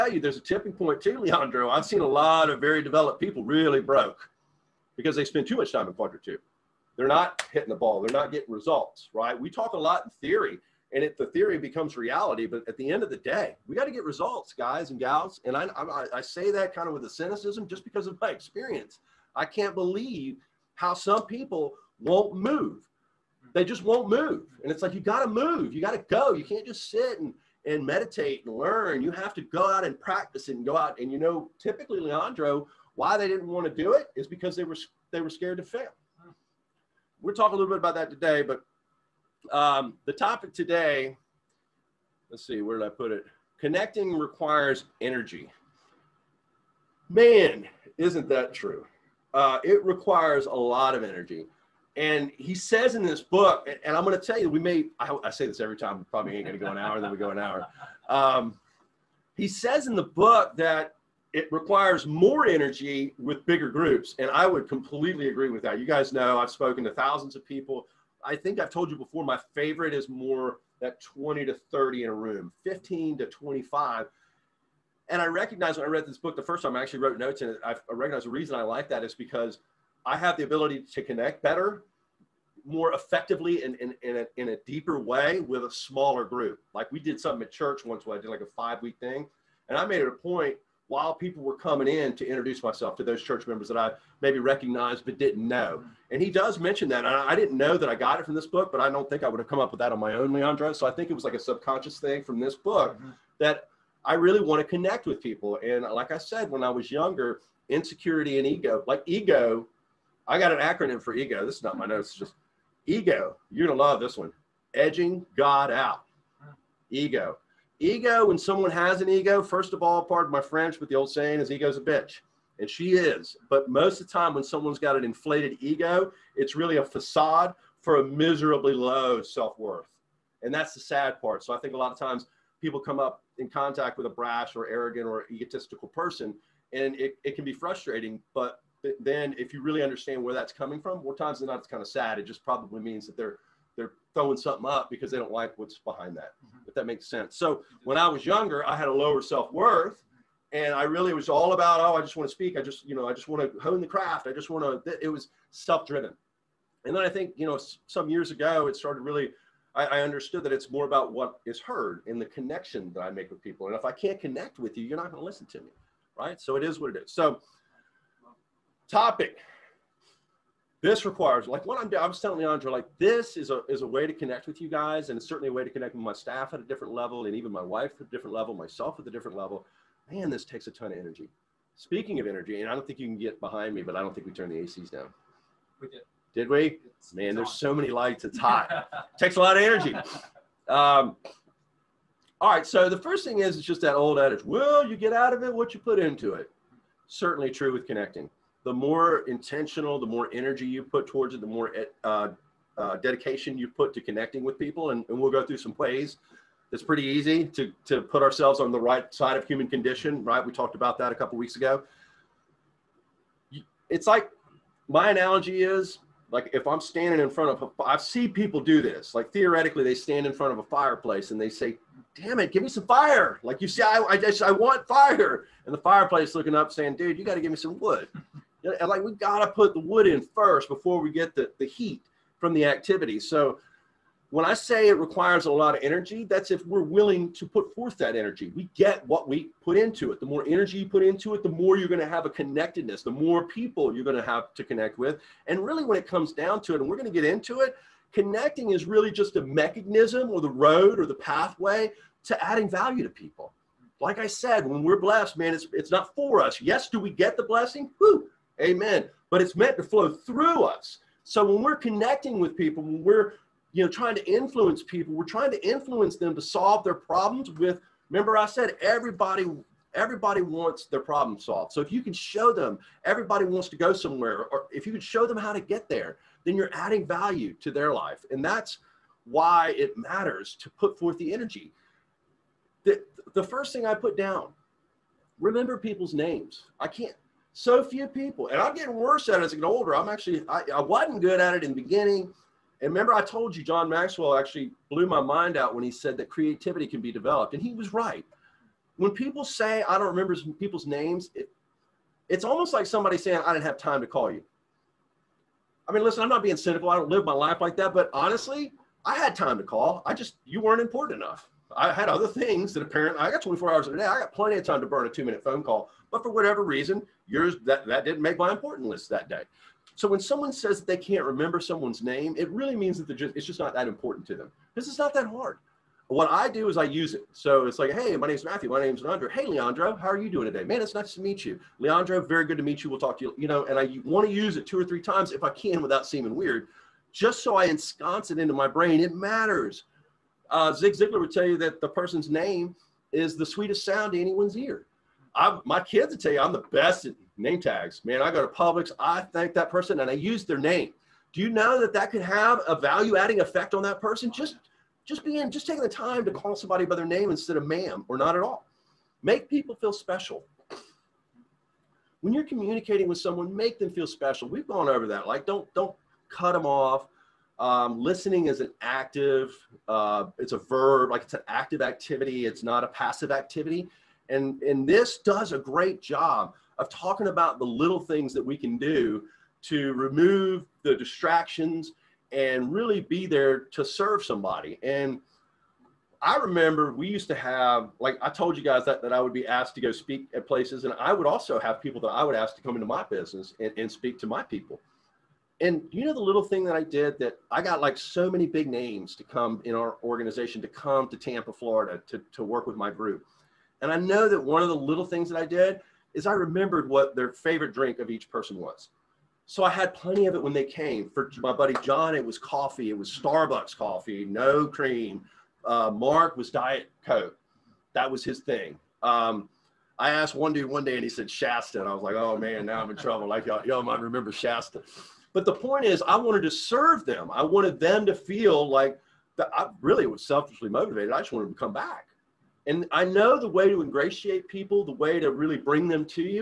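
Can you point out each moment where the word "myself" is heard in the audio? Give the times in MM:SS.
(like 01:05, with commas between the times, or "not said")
01:32, 02:58.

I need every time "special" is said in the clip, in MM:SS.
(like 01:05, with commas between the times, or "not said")
05:59, 06:04.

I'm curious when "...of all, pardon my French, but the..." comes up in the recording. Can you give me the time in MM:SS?
01:59.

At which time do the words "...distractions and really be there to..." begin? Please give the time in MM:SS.
06:20.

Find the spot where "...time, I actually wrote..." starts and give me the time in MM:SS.
01:16.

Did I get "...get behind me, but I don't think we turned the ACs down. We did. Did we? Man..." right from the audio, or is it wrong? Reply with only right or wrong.
right.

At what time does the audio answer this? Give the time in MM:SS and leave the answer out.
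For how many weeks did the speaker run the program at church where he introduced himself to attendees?
01:28.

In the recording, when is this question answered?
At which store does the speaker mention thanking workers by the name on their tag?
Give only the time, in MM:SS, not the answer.
05:48.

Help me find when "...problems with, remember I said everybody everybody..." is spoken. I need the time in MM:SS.
04:26.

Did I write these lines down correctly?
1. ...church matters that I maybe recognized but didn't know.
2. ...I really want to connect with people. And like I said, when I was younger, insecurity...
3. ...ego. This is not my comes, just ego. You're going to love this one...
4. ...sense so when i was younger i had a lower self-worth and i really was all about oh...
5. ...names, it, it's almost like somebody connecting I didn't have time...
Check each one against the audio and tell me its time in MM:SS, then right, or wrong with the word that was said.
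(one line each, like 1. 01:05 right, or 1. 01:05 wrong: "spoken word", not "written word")
1. 01:33 wrong: "members", not "matters"
2. 01:44 right
3. 01:51 wrong: "notes", not "comes"
4. 02:27 right
5. 05:00 wrong: "saying", not "connecting".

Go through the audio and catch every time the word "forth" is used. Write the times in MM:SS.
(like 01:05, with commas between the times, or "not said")
03:57, 04:40.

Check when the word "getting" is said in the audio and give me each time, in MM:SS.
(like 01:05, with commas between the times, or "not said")
00:08, 04:48.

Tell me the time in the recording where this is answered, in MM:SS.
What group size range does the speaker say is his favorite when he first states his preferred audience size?
01:11.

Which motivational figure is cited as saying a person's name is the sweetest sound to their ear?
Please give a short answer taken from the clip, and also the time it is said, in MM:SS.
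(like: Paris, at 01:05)
Zig Ziglar, at 05:40.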